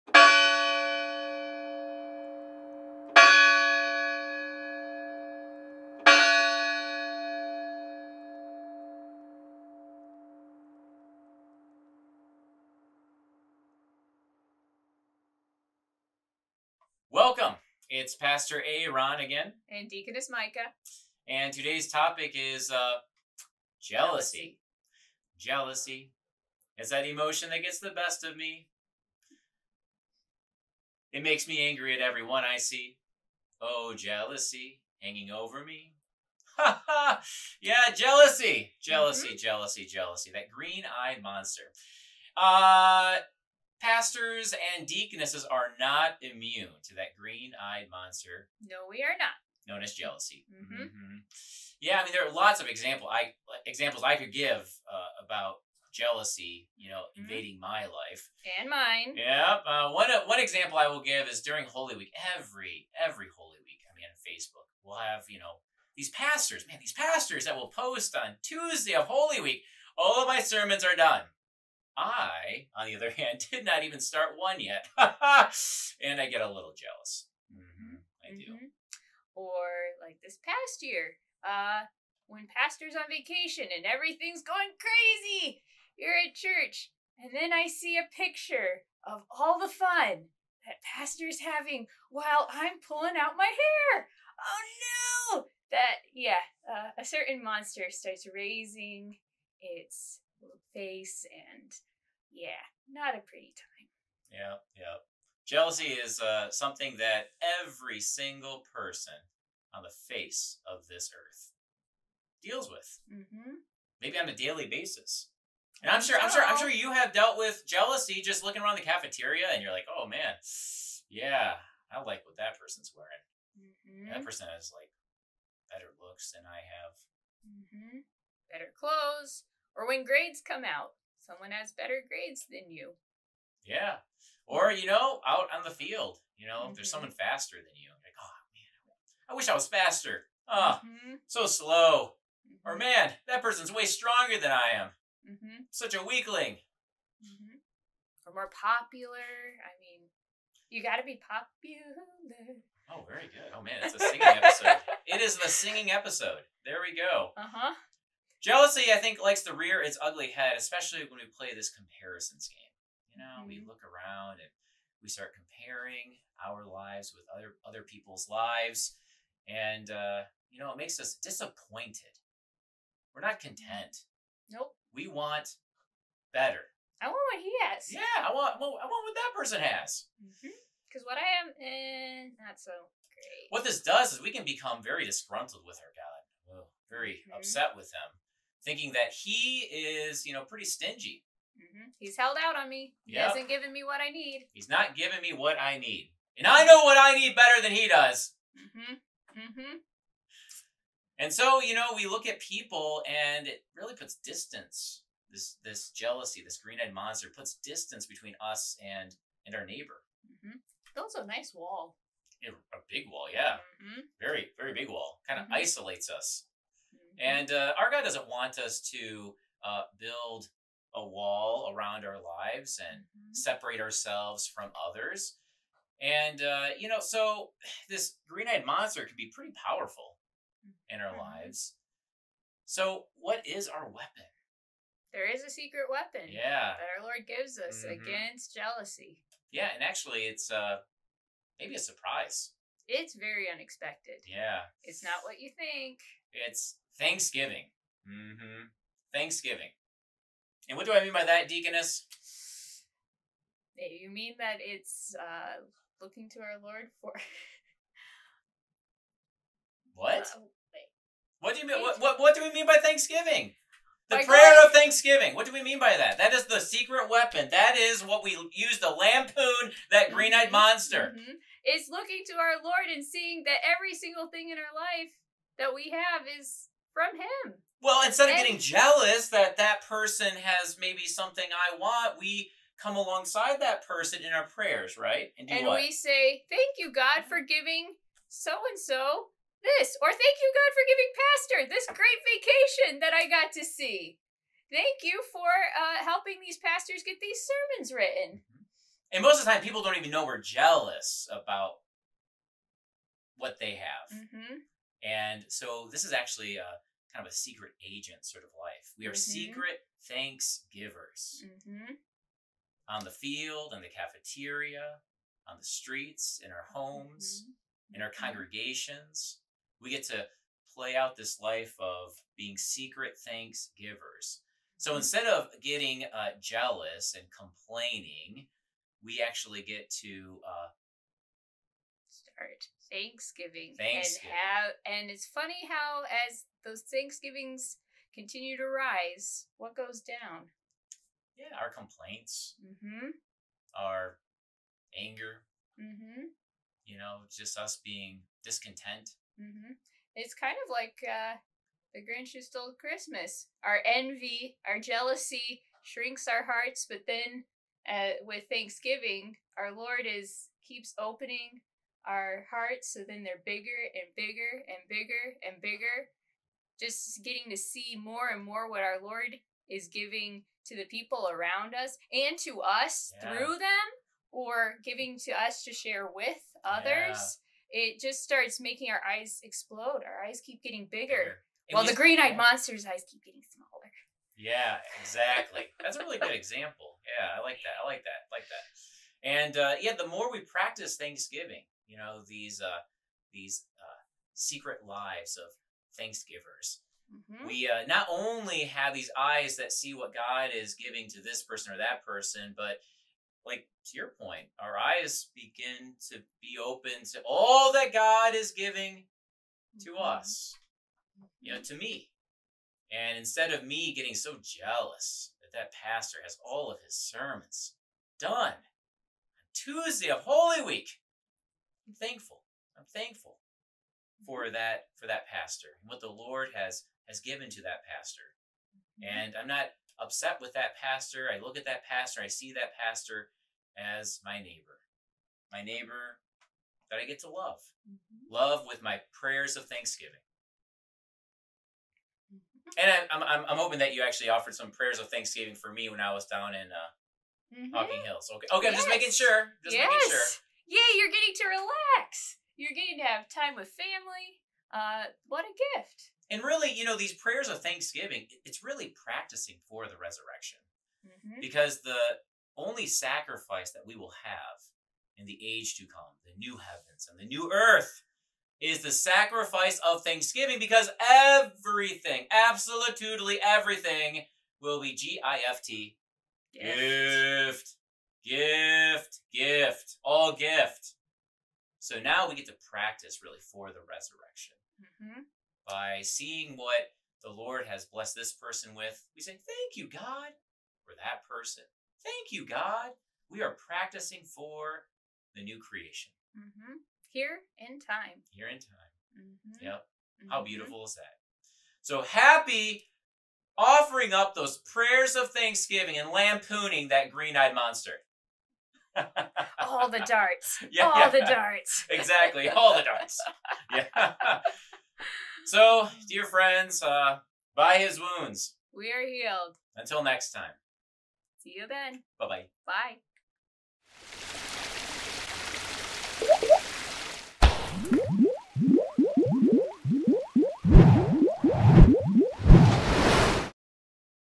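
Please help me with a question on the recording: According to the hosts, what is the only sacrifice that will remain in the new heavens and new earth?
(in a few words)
The sacrifice of thanksgiving.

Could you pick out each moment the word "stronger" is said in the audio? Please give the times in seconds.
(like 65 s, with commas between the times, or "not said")
143 s.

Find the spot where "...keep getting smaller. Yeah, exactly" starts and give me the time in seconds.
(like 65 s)
383 s.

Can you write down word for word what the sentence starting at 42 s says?
Uh, Pastors and deaconesses are not immune to that green eyed monster.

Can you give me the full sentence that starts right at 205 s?
This this jealousy, this green-eyed monster puts distance between us and and our neighbor.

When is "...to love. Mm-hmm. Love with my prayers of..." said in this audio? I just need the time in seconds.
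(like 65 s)
437 s.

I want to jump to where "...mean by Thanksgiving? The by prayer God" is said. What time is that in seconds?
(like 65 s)
262 s.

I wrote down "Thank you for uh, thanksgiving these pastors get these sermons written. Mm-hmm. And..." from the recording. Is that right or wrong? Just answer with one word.
wrong.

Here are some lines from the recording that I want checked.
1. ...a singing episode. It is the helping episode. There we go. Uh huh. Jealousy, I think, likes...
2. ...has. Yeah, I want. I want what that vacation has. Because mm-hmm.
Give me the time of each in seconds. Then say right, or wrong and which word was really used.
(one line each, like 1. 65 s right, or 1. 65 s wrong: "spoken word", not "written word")
1. 153 s wrong: "singing", not "helping"
2. 177 s wrong: "person", not "vacation".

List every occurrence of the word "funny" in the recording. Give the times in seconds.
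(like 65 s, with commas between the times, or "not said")
335 s.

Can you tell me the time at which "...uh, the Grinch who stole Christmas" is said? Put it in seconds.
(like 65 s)
351 s.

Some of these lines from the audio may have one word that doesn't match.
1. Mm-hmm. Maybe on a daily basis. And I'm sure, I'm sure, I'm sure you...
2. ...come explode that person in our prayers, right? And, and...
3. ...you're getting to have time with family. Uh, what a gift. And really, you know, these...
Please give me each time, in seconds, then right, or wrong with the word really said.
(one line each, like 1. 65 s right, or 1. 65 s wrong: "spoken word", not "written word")
1. 113 s right
2. 282 s wrong: "alongside", not "explode"
3. 452 s right.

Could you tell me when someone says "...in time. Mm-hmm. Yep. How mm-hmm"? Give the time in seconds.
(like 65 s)
498 s.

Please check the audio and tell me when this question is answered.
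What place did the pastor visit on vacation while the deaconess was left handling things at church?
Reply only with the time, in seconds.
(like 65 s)
447 s.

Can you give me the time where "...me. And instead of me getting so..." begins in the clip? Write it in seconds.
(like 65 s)
411 s.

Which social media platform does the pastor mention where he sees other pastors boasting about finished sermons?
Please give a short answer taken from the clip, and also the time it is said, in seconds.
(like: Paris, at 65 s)
Facebook, at 64 s.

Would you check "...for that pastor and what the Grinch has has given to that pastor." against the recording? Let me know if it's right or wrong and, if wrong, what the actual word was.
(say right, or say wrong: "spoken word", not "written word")
wrong: "Lord", not "Grinch".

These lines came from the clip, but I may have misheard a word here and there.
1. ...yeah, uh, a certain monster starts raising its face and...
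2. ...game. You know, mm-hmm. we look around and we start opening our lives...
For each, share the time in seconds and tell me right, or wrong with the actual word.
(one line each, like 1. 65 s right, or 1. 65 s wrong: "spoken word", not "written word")
1. 96 s right
2. 162 s wrong: "comparing", not "opening".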